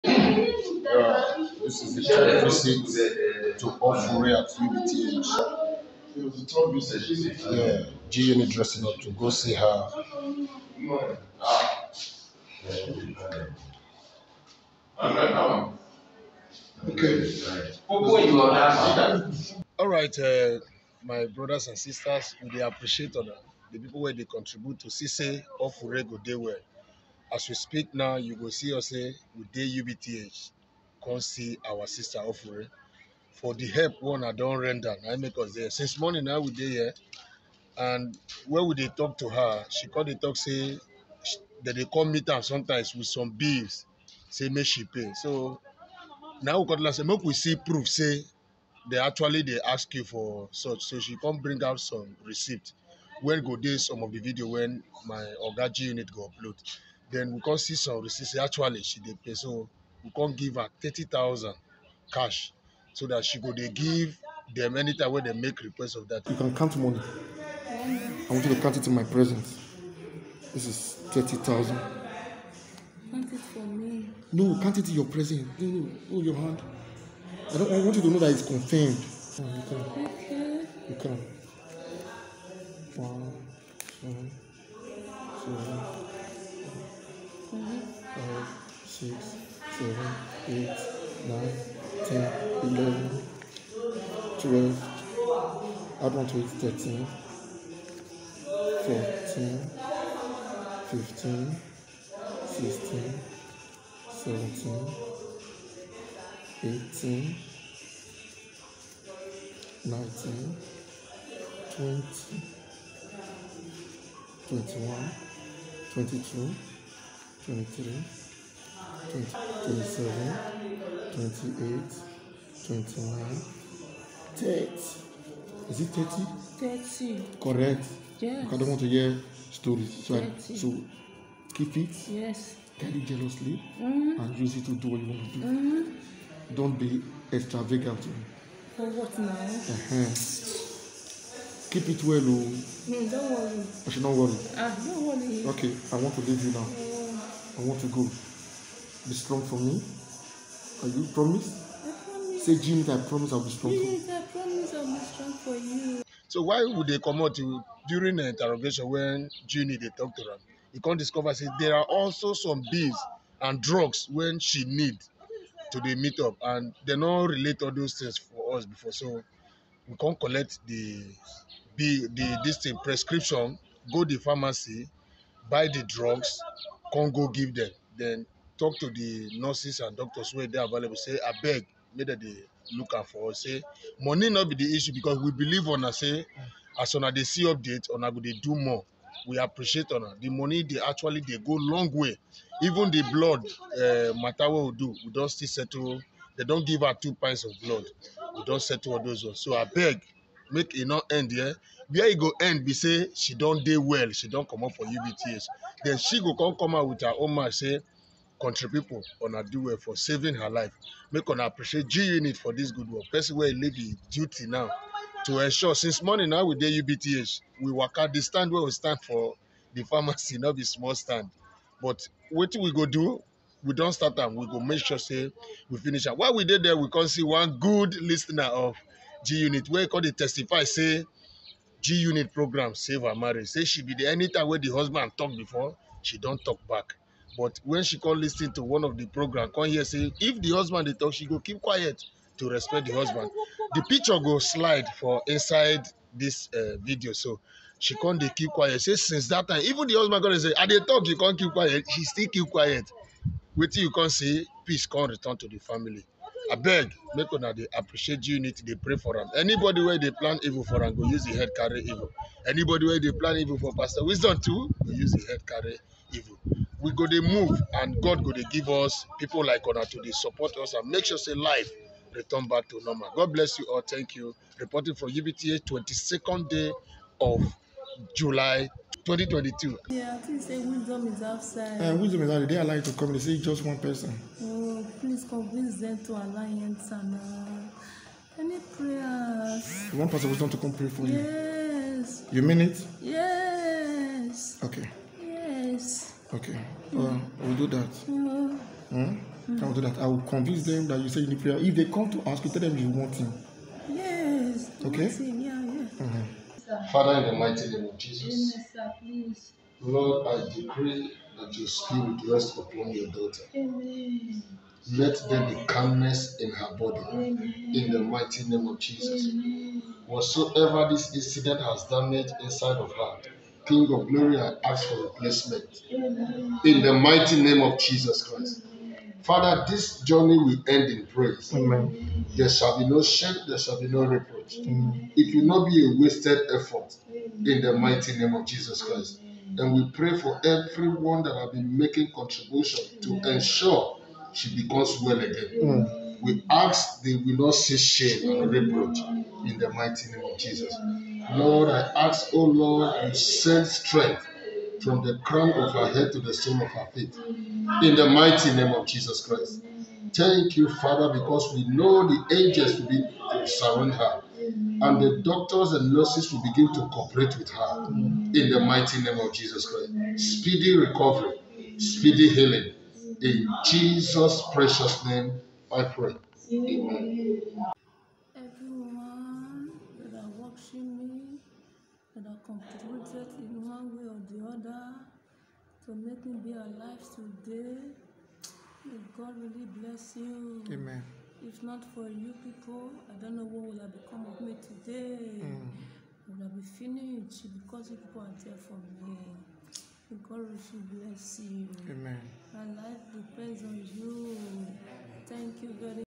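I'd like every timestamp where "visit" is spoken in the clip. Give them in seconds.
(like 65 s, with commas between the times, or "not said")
2 s, 6 s.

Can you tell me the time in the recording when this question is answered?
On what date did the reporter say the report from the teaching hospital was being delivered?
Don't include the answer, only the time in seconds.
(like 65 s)
275 s.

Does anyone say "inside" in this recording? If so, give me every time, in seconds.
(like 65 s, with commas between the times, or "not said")
245 s, 322 s.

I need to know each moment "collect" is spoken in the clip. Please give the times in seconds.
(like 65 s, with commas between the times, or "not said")
170 s.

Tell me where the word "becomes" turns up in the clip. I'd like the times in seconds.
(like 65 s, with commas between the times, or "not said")
344 s, 393 s.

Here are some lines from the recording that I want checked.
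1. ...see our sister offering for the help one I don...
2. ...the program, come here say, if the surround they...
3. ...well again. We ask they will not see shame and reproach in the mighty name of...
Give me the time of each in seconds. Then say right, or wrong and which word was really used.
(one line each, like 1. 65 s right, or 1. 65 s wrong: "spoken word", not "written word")
1. 31 s right
2. 238 s wrong: "husband", not "surround"
3. 345 s right.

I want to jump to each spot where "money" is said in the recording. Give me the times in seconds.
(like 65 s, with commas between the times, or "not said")
66 s, 183 s, 190 s.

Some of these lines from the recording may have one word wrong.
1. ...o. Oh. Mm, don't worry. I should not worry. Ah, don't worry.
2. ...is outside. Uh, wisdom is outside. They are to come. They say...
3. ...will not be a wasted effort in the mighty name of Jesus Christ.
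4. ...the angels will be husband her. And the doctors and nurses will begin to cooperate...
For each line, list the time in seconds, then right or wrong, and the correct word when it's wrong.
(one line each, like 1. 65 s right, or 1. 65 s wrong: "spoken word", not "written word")
1. 142 s right
2. 281 s right
3. 335 s right
4. 362 s wrong: "surround", not "husband".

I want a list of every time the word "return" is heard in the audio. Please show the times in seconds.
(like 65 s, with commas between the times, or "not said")
255 s, 272 s.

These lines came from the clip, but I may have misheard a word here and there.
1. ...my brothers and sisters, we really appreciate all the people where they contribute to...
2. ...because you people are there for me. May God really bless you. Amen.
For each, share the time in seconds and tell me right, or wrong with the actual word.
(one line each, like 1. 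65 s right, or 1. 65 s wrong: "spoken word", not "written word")
1. 21 s right
2. 397 s right.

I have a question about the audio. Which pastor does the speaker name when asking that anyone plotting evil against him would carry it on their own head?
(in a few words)
Pastor Wisdom.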